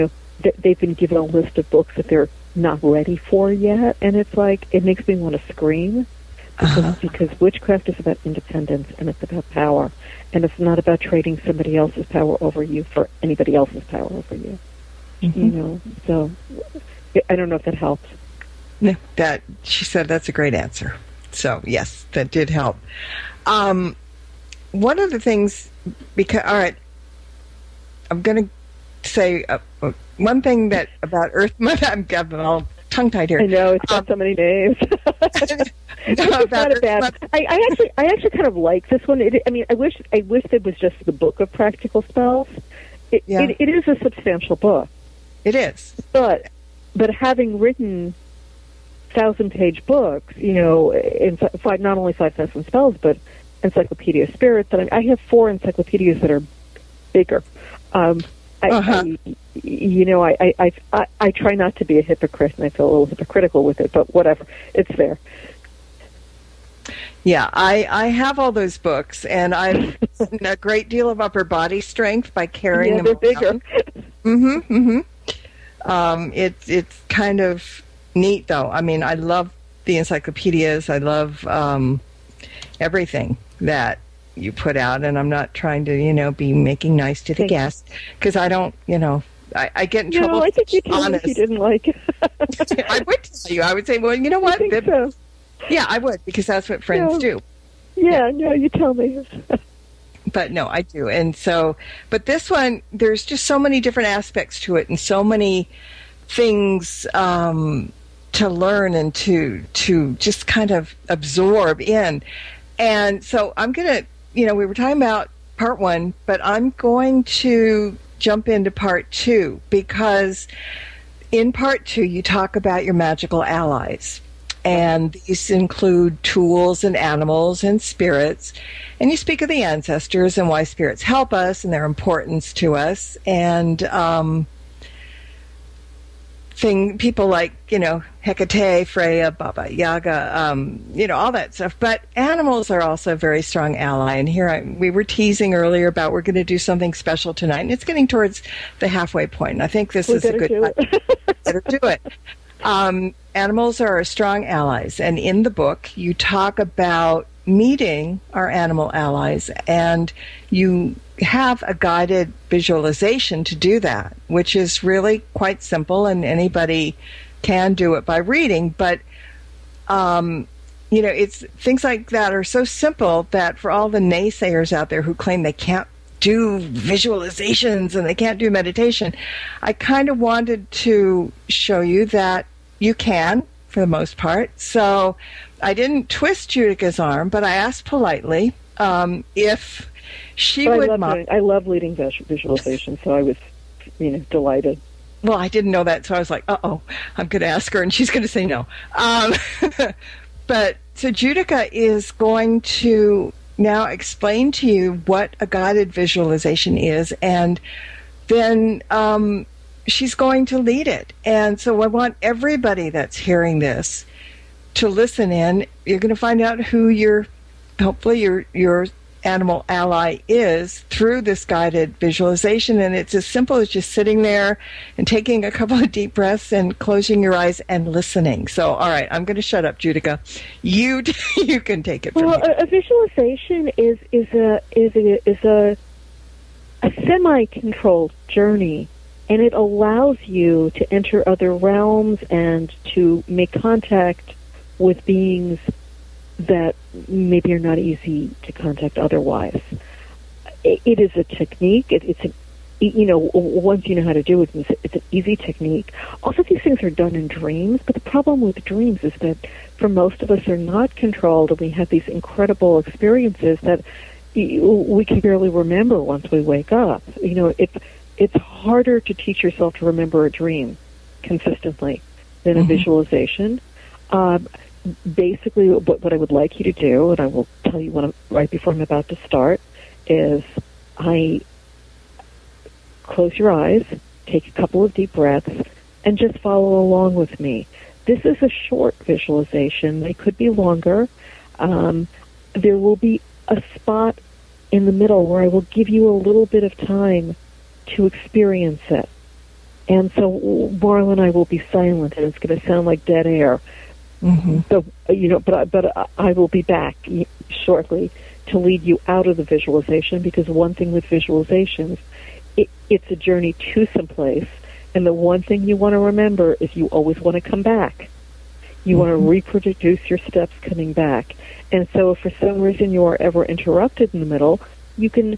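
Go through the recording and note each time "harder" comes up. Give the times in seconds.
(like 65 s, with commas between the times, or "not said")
268 s.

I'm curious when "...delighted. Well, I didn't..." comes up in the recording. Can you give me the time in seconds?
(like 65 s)
194 s.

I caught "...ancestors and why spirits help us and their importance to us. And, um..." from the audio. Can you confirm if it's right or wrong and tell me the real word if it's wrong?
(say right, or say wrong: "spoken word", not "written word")
right.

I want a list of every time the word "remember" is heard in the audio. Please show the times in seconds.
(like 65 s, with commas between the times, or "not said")
265 s, 269 s, 315 s.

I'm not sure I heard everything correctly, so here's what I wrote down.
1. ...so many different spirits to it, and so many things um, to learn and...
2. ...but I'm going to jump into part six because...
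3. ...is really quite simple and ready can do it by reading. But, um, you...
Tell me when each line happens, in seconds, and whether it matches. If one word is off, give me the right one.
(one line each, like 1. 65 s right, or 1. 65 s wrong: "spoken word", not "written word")
1. 103 s wrong: "aspects", not "spirits"
2. 116 s wrong: "two", not "six"
3. 164 s wrong: "anybody", not "ready".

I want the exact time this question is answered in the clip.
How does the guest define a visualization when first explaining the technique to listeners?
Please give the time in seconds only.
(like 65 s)
236 s.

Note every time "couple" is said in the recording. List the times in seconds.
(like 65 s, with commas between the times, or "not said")
225 s, 284 s.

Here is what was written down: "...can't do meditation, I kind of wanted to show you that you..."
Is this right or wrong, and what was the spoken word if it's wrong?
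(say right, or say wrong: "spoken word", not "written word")
right.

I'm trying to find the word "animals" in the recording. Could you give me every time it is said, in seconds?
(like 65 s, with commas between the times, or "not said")
126 s, 142 s, 153 s, 158 s, 219 s.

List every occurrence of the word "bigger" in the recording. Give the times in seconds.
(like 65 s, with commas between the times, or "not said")
57 s, 73 s.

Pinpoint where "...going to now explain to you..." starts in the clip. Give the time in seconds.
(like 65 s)
202 s.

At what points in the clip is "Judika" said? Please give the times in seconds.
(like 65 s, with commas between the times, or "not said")
186 s, 201 s, 229 s.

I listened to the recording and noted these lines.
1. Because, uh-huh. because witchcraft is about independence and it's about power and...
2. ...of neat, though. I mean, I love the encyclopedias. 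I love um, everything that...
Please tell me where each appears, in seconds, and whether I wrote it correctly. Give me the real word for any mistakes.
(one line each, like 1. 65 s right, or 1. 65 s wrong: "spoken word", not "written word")
1. 6 s right
2. 77 s right.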